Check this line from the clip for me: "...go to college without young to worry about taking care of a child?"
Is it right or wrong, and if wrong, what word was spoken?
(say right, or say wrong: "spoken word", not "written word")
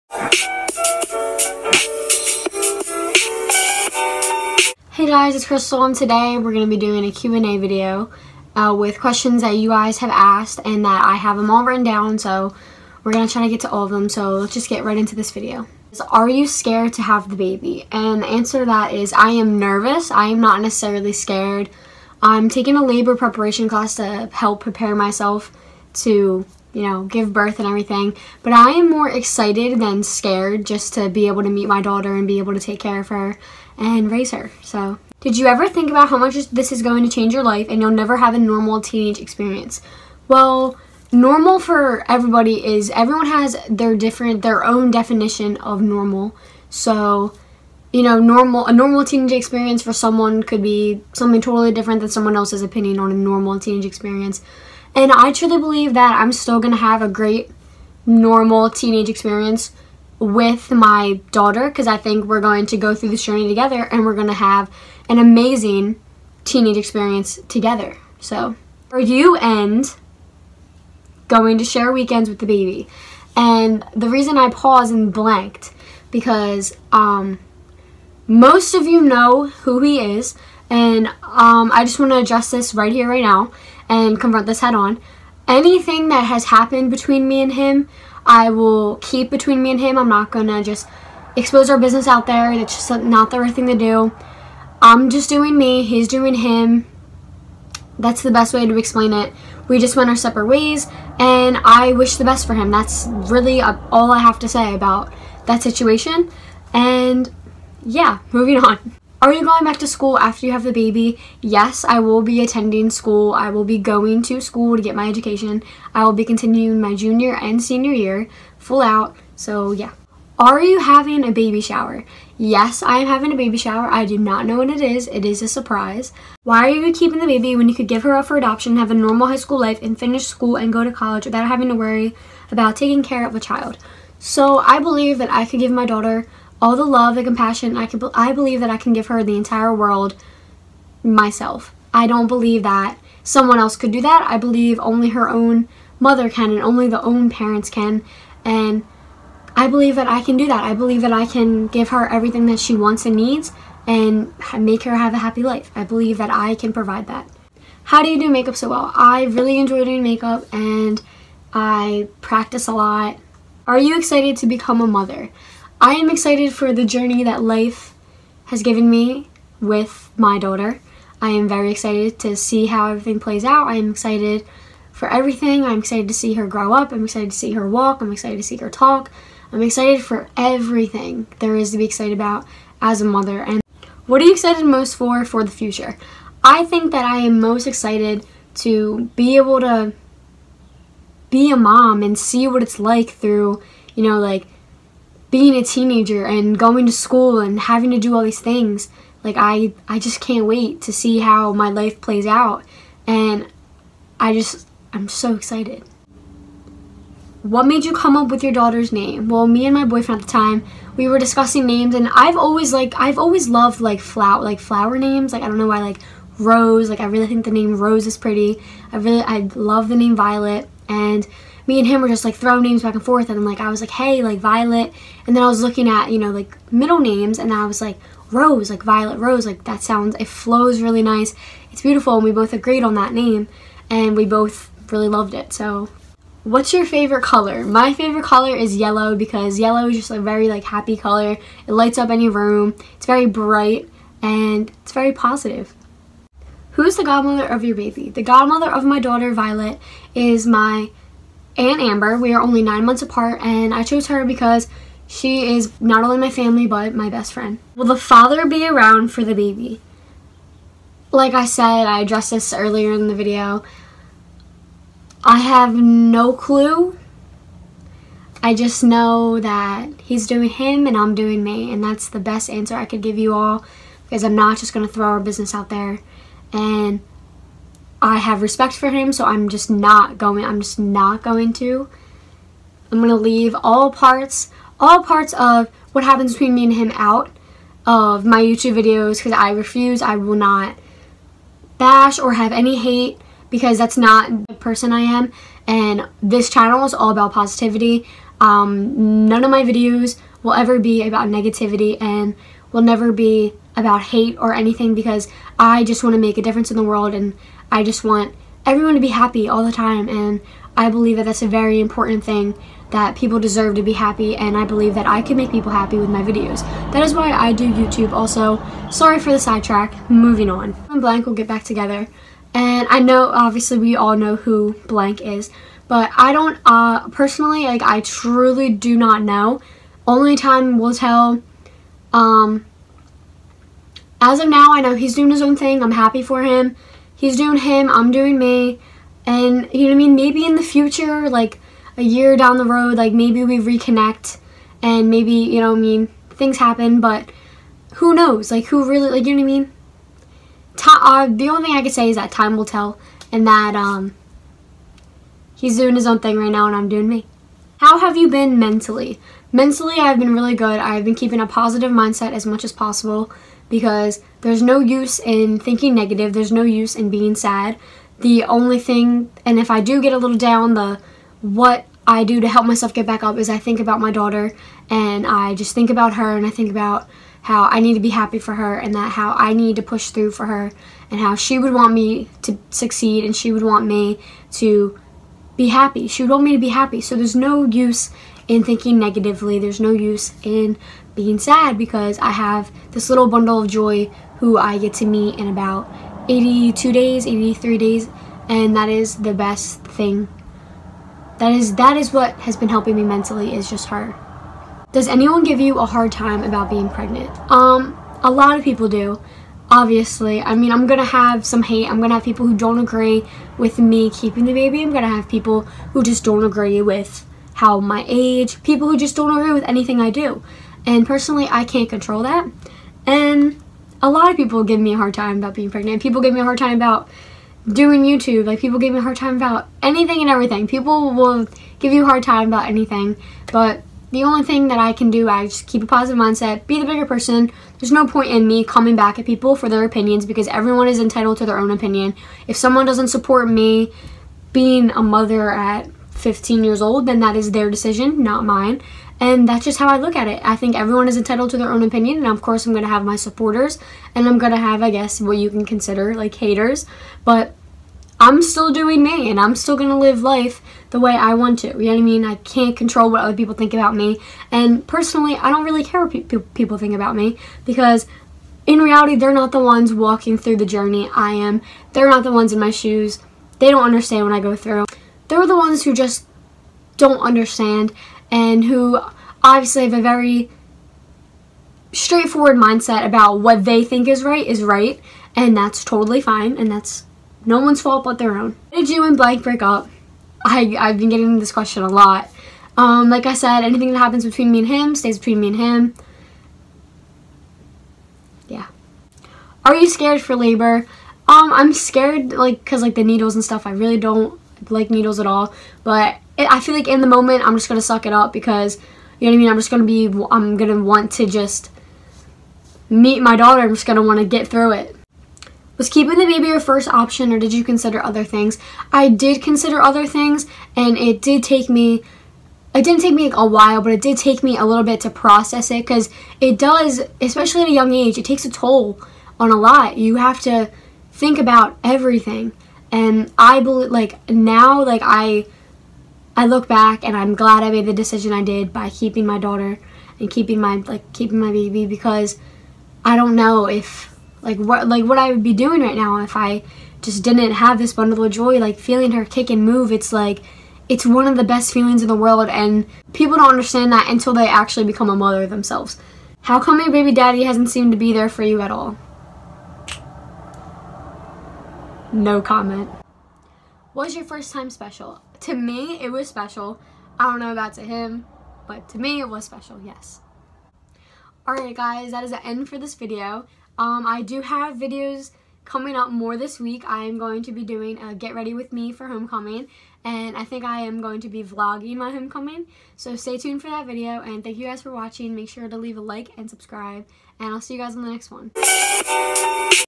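wrong: "having", not "young".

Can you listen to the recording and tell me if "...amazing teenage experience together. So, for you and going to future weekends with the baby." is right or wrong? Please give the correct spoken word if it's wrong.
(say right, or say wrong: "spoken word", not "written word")
wrong: "share", not "future".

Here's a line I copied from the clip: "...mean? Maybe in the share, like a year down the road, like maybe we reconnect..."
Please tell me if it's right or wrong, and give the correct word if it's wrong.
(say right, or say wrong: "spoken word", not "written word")
wrong: "future", not "share".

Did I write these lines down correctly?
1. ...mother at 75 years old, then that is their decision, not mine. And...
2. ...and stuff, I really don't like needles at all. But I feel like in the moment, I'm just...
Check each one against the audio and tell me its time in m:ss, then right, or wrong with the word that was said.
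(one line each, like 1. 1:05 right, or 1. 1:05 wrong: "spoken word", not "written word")
1. 7:25 wrong: "15", not "75"
2. 8:23 right.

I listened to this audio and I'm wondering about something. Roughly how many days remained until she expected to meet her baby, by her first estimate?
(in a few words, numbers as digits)
82.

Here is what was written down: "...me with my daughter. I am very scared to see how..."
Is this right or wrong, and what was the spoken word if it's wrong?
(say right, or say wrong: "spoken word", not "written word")
wrong: "excited", not "scared".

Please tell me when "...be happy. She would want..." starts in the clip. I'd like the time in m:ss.
6:25.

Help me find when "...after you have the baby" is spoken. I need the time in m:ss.
1:50.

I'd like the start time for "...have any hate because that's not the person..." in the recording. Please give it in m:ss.
4:52.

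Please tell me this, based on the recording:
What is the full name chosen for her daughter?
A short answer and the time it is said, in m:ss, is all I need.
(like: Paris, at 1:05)
Violet Rose, at 3:48.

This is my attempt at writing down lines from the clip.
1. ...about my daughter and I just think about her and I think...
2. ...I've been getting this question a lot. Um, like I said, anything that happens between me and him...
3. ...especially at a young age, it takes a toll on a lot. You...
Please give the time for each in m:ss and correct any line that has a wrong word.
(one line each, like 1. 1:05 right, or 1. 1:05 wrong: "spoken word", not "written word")
1. 6:13 right
2. 8:10 right
3. 8:47 right.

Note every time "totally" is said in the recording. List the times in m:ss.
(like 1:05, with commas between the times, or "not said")
0:51, 8:05.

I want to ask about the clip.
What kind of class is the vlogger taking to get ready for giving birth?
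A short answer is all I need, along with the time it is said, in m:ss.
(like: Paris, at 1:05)
Labor preparation class, at 0:22.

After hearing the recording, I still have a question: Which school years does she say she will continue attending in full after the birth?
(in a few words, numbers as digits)
Junior and senior year.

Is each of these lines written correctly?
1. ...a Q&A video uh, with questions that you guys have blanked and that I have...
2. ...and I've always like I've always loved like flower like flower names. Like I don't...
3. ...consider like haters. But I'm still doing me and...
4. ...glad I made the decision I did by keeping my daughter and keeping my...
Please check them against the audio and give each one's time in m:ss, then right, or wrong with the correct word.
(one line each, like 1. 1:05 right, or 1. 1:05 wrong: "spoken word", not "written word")
1. 0:07 wrong: "asked", not "blanked"
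2. 3:31 right
3. 7:35 right
4. 8:57 right.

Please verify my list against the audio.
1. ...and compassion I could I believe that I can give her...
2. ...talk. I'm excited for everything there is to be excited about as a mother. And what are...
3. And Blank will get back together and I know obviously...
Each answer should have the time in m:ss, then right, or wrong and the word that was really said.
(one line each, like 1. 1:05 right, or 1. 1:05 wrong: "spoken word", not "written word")
1. 2:17 right
2. 2:58 right
3. 5:20 right.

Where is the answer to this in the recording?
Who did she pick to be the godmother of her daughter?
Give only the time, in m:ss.
4:11.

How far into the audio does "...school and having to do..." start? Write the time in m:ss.
3:16.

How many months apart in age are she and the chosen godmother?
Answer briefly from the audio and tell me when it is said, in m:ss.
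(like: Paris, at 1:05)
9, at 4:12.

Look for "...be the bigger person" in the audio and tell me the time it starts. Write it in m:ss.
7:16.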